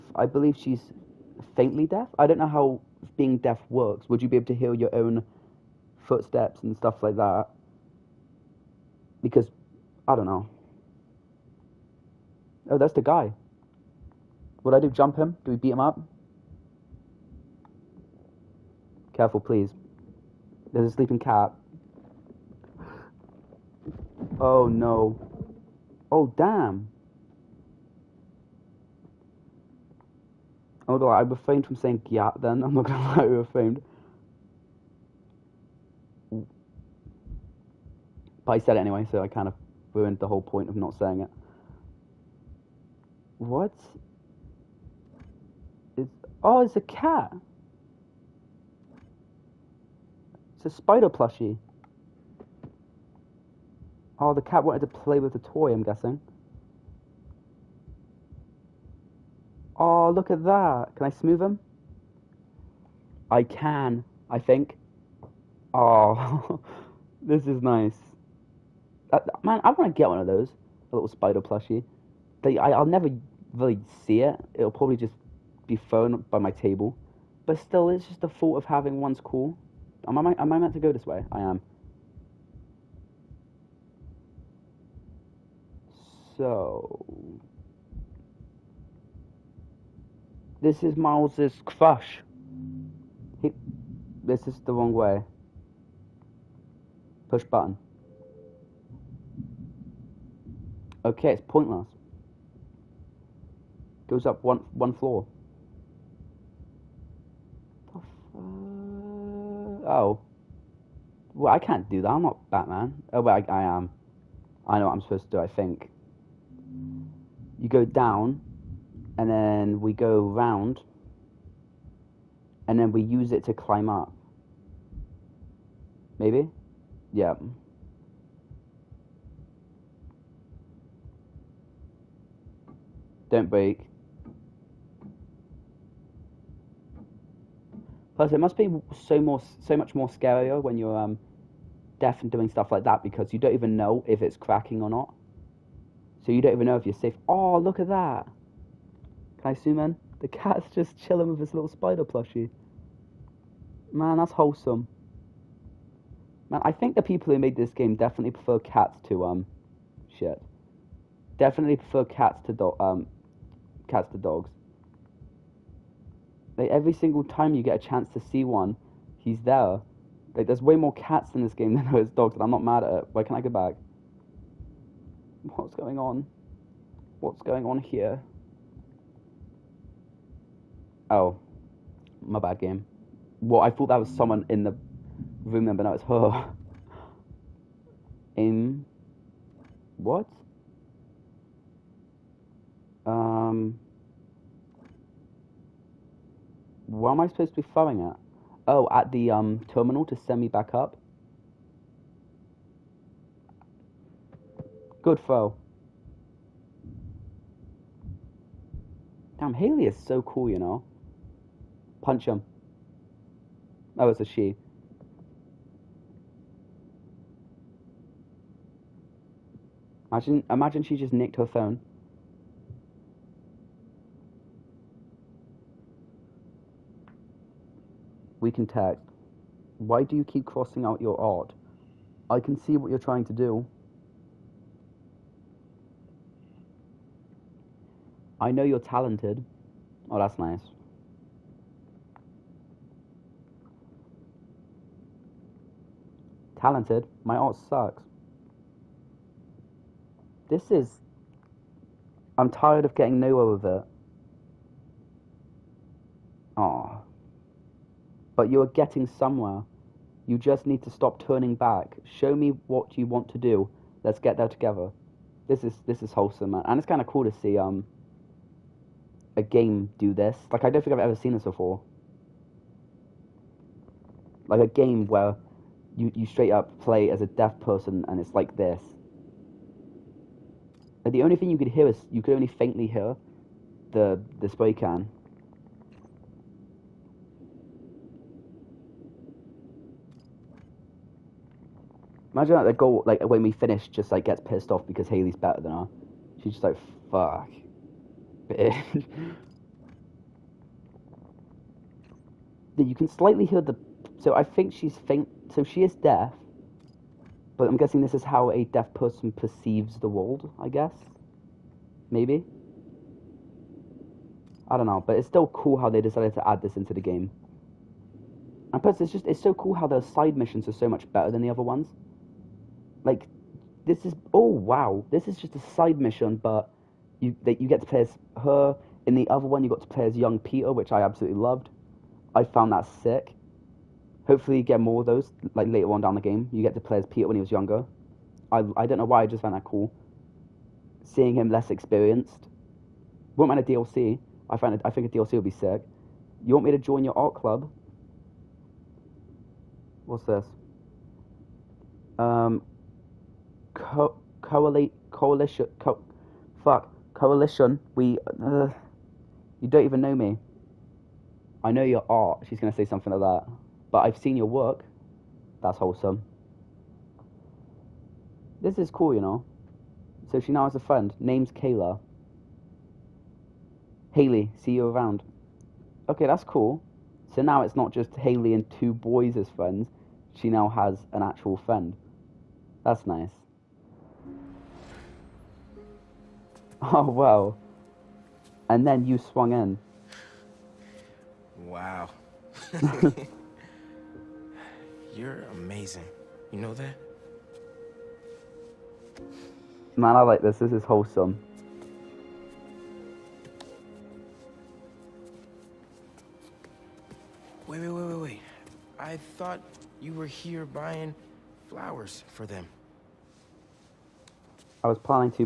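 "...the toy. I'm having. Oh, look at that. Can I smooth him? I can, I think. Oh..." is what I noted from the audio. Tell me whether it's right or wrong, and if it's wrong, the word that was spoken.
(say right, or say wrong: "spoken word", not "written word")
wrong: "guessing", not "having".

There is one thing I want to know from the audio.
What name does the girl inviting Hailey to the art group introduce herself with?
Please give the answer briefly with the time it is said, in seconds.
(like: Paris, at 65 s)
Kayla, at 371 s.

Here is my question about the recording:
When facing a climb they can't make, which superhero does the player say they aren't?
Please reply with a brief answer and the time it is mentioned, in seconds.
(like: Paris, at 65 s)
Batman, at 112 s.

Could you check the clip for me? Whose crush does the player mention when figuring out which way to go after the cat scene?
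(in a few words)
Mouse.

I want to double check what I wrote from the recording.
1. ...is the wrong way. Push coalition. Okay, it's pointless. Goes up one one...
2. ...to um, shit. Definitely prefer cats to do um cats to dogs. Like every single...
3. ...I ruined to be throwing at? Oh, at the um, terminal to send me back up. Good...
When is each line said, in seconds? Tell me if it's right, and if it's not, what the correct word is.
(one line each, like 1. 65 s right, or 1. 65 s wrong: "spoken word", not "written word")
1. 94 s wrong: "button", not "coalition"
2. 159 s right
3. 197 s wrong: "supposed", not "ruined".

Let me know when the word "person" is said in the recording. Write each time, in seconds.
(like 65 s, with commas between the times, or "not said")
277 s, 308 s.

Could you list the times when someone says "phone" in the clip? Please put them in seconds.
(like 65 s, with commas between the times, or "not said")
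221 s.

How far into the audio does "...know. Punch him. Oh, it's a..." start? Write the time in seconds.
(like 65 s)
210 s.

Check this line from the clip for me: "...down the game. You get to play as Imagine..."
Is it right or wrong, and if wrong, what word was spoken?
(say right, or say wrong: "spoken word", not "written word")
wrong: "Peter", not "Imagine".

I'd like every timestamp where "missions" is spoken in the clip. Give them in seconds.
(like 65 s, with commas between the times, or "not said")
320 s, 325 s.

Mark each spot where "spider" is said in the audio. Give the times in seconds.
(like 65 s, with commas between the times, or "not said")
50 s, 71 s, 151 s.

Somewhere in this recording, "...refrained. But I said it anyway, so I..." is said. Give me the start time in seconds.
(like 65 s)
33 s.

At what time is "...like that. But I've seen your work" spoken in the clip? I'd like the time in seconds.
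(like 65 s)
363 s.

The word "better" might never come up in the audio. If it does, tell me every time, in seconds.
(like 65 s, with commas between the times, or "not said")
295 s, 321 s.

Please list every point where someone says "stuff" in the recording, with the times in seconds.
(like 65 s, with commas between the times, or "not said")
6 s, 142 s.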